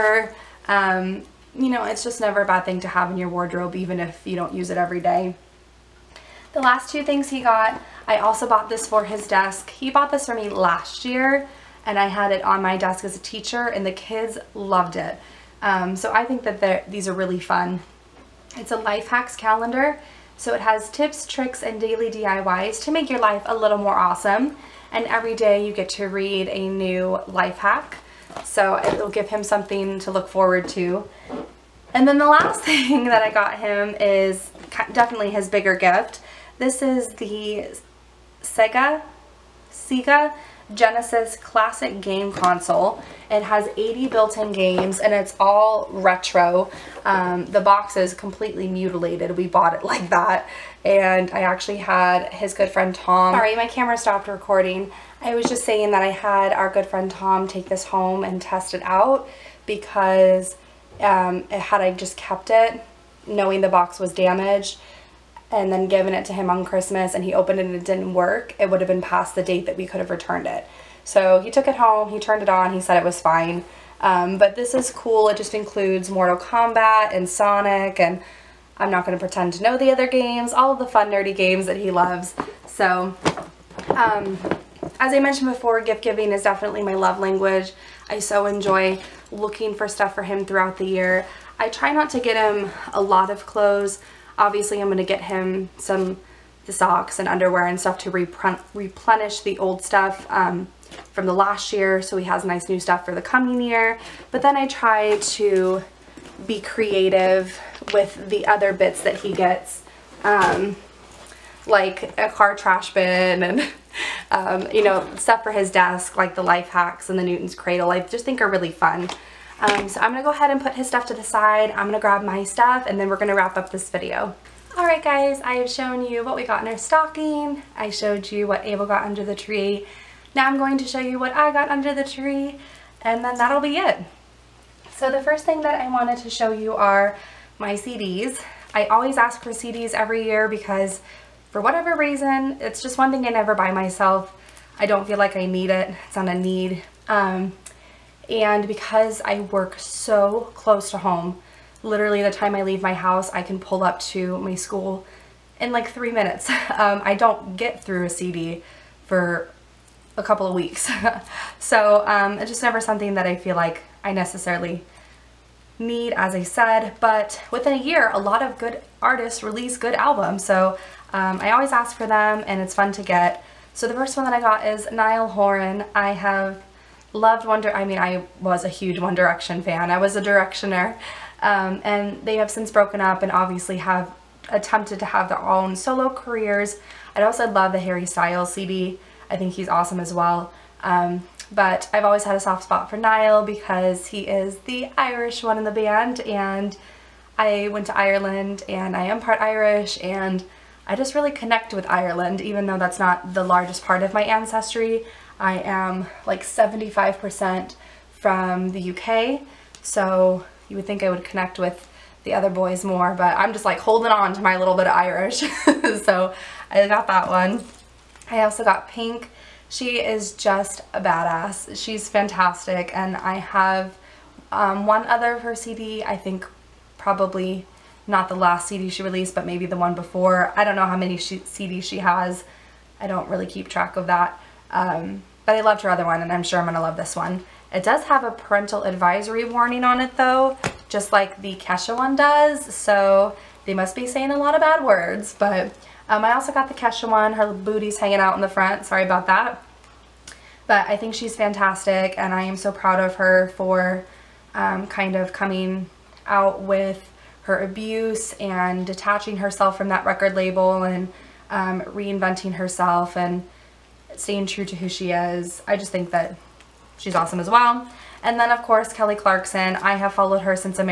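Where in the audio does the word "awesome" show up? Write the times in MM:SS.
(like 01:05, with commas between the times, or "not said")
00:23, 03:09, 04:27.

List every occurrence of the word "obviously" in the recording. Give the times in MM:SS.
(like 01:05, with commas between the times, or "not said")
01:34, 03:03.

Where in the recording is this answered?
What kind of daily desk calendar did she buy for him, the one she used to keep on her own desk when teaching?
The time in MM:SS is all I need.
00:18.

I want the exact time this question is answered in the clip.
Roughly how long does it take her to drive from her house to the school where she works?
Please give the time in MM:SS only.
02:35.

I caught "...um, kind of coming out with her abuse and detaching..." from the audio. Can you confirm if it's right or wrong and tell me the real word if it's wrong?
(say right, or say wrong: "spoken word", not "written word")
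right.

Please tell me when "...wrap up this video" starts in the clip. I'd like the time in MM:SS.
02:03.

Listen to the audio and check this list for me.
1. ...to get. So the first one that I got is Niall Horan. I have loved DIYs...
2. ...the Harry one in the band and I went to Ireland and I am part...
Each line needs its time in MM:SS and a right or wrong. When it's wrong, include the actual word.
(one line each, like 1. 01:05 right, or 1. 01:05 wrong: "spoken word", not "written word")
1. 02:52 wrong: "One", not "DIYs"
2. 03:14 wrong: "Irish", not "Harry".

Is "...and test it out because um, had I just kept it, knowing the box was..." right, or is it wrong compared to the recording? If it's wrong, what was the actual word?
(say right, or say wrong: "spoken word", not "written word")
right.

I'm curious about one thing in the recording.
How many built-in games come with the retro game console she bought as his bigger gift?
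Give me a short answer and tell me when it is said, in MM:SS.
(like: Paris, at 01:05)
80, at 00:43.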